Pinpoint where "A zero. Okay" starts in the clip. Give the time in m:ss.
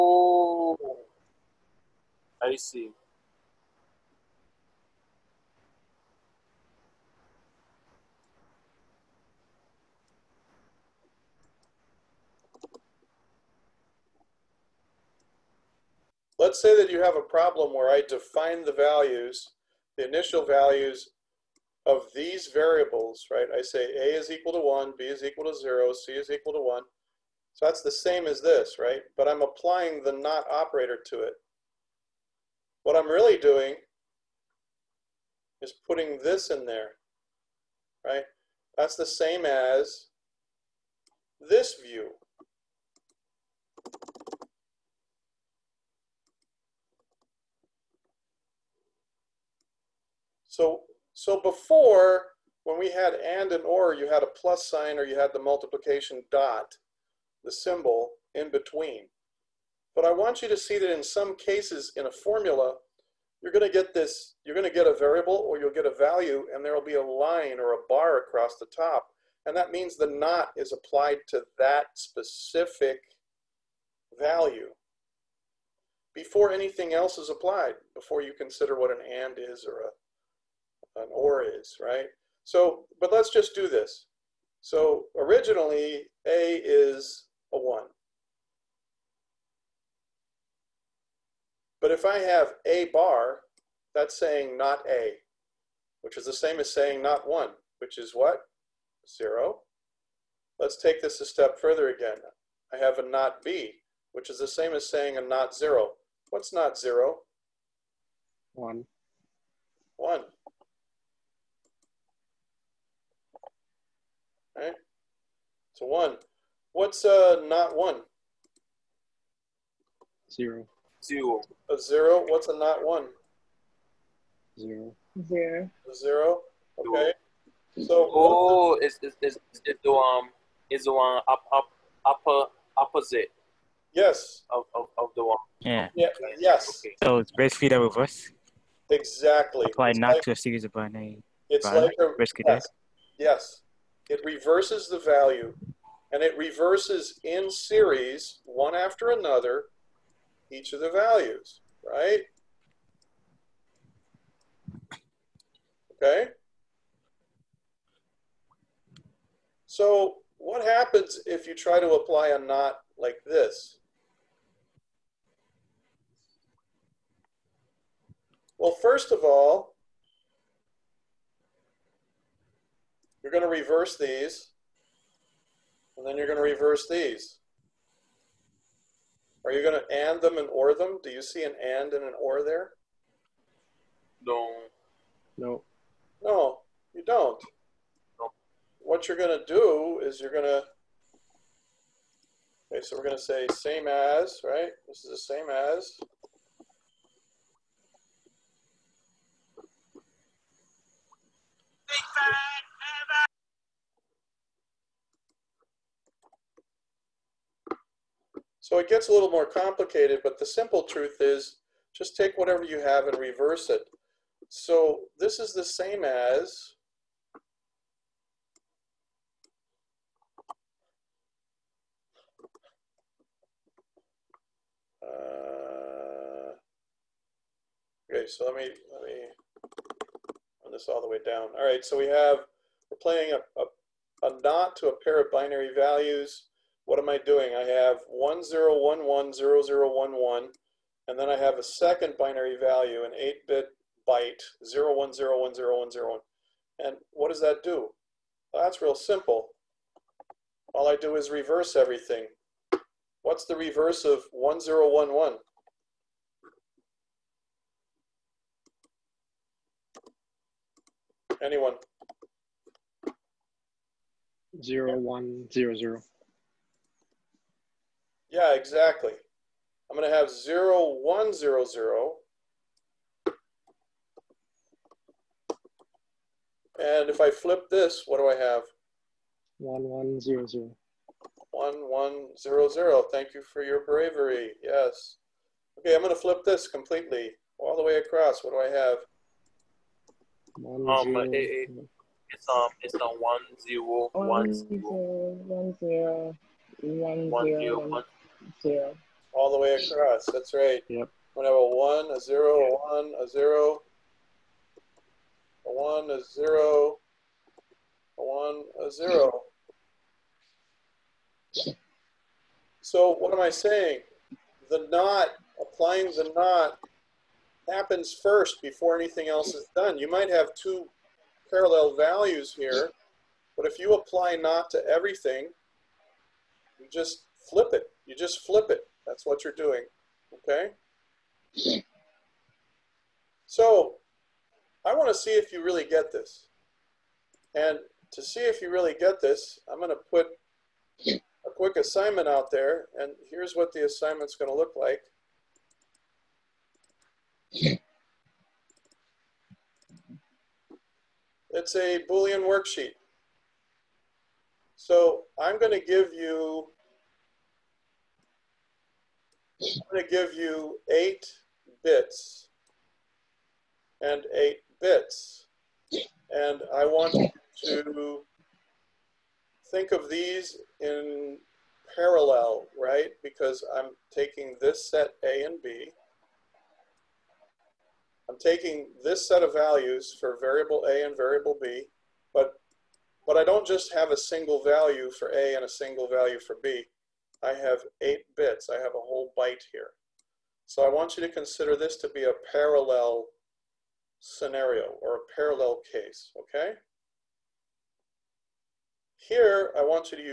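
2:05.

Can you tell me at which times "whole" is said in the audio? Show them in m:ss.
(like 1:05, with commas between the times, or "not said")
6:29.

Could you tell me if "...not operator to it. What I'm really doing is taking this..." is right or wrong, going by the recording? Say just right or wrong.
wrong.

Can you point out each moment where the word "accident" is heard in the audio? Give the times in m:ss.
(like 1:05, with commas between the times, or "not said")
not said.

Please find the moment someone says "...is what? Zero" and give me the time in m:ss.
1:37.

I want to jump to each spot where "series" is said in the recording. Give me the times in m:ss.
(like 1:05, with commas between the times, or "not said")
2:20, 2:27.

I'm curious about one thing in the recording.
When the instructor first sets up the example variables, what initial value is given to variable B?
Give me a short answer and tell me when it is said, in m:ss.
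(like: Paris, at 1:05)
0, at 0:24.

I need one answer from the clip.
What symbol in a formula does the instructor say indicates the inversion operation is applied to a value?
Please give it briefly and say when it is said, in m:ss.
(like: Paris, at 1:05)
a line or a bar across the top, at 1:07.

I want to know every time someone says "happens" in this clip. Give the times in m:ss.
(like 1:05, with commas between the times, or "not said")
2:40, 5:17.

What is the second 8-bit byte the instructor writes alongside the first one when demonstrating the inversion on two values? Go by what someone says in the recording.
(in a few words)
01010101.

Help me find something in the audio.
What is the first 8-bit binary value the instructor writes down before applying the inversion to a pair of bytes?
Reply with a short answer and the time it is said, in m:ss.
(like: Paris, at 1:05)
10110011, at 3:58.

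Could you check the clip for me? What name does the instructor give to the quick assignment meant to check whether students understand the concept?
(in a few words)
Boolean worksheet.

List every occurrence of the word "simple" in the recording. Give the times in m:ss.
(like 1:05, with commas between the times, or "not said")
3:30, 4:08.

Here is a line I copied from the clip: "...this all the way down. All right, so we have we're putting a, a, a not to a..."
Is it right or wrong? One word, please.
wrong.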